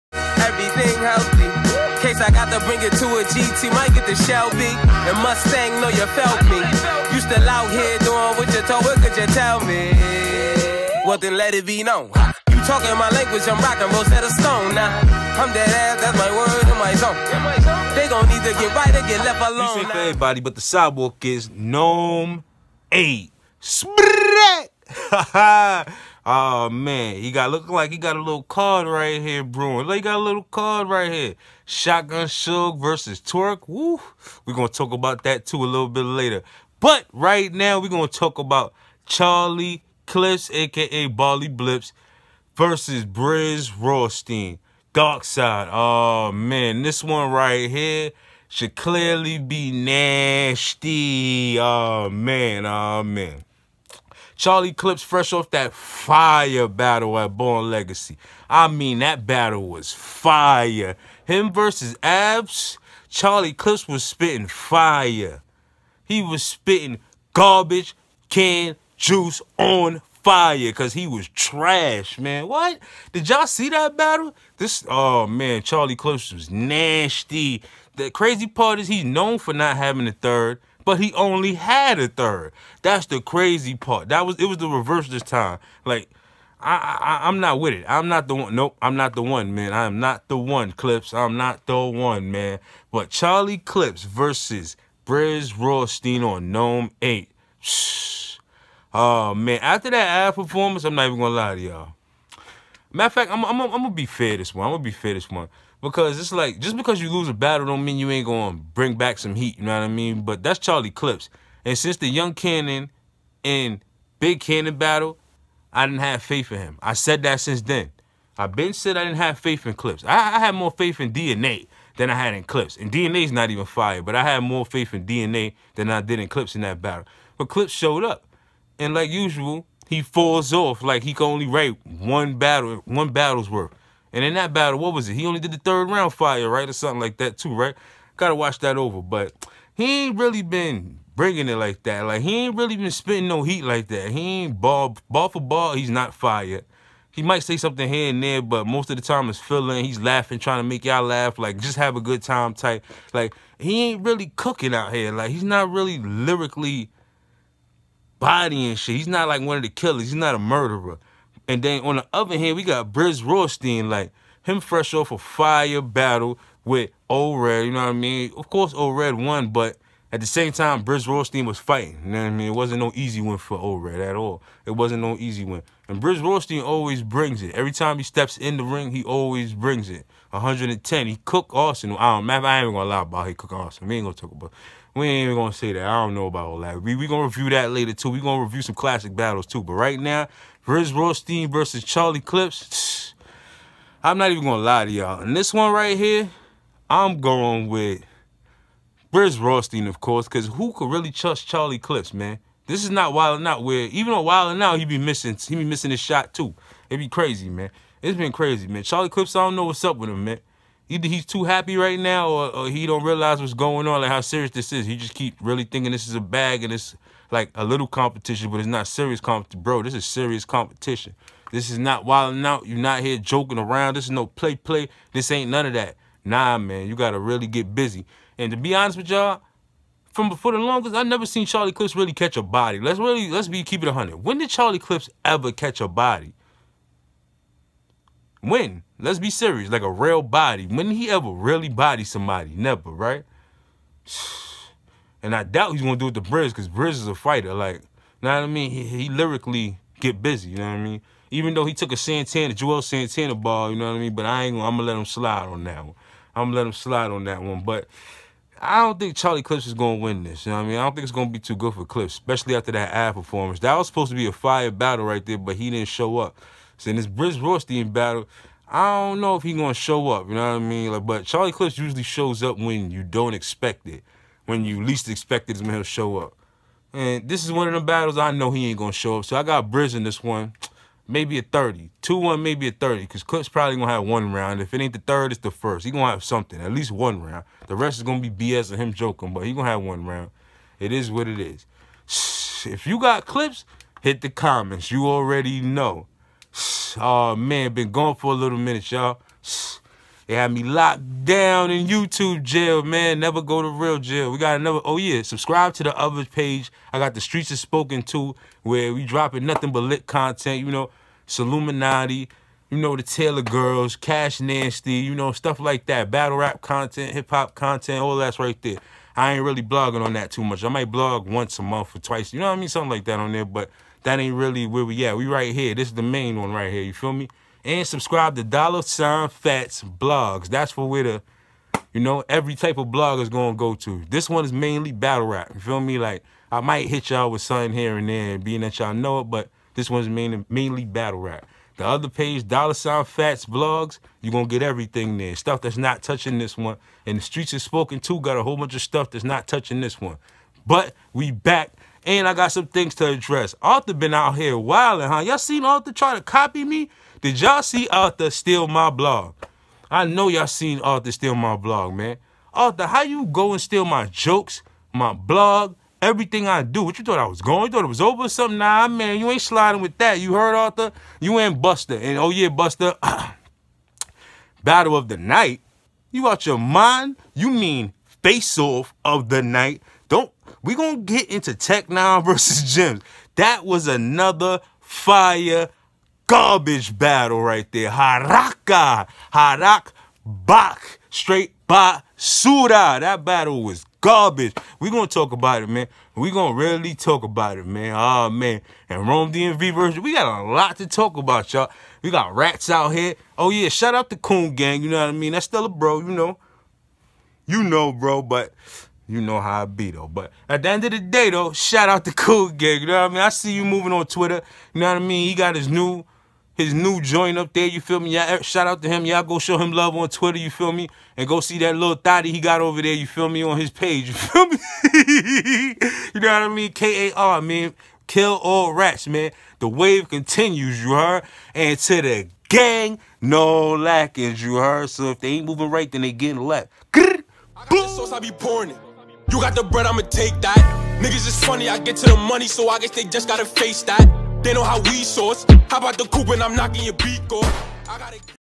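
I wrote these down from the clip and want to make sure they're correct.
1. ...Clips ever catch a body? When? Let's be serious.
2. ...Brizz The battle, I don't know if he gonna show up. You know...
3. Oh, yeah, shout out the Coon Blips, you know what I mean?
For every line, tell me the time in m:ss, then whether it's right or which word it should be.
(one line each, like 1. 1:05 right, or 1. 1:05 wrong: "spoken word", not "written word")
1. 3:54 right
2. 4:27 wrong: "Rawsteen", not "The"
3. 6:43 wrong: "Gang", not "Blips".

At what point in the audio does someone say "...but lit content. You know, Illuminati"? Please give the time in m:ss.
5:09.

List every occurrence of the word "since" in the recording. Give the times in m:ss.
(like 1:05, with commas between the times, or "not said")
1:51, 1:57.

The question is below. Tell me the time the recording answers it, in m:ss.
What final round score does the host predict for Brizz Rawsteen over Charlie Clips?
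4:42.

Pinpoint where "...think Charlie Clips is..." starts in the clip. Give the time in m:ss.
4:18.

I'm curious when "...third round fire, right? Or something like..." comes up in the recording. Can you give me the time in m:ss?
2:15.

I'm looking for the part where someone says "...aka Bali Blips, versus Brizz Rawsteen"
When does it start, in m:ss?
0:40.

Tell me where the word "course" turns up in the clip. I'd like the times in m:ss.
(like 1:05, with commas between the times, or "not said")
2:48, 3:19.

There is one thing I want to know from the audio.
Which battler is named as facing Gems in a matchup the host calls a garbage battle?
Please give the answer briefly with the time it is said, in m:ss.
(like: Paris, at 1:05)
Tech Nine, at 6:21.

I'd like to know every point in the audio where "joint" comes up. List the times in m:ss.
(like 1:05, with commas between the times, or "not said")
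6:57.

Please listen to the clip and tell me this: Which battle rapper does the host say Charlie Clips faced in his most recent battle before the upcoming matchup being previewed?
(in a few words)
Abs.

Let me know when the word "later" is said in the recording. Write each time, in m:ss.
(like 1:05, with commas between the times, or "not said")
0:36, 3:07.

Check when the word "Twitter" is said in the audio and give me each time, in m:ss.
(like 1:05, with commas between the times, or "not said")
6:54, 7:00.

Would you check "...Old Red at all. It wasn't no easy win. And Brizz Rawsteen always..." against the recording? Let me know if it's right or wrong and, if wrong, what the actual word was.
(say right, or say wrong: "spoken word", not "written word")
right.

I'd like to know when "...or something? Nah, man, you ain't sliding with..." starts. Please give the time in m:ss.
6:08.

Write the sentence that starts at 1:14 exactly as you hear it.
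This, oh man, Charlie Clips was nasty.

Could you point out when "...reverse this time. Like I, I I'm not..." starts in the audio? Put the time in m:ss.
1:24.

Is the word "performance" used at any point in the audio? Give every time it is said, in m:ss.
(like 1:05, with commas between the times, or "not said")
1:40, 4:23.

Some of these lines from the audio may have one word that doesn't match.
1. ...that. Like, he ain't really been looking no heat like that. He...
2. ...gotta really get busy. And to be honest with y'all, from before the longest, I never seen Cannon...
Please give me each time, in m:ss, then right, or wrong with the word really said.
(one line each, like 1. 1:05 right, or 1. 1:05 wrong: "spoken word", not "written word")
1. 2:21 wrong: "spitting", not "looking"
2. 3:46 wrong: "Charlie", not "Cannon".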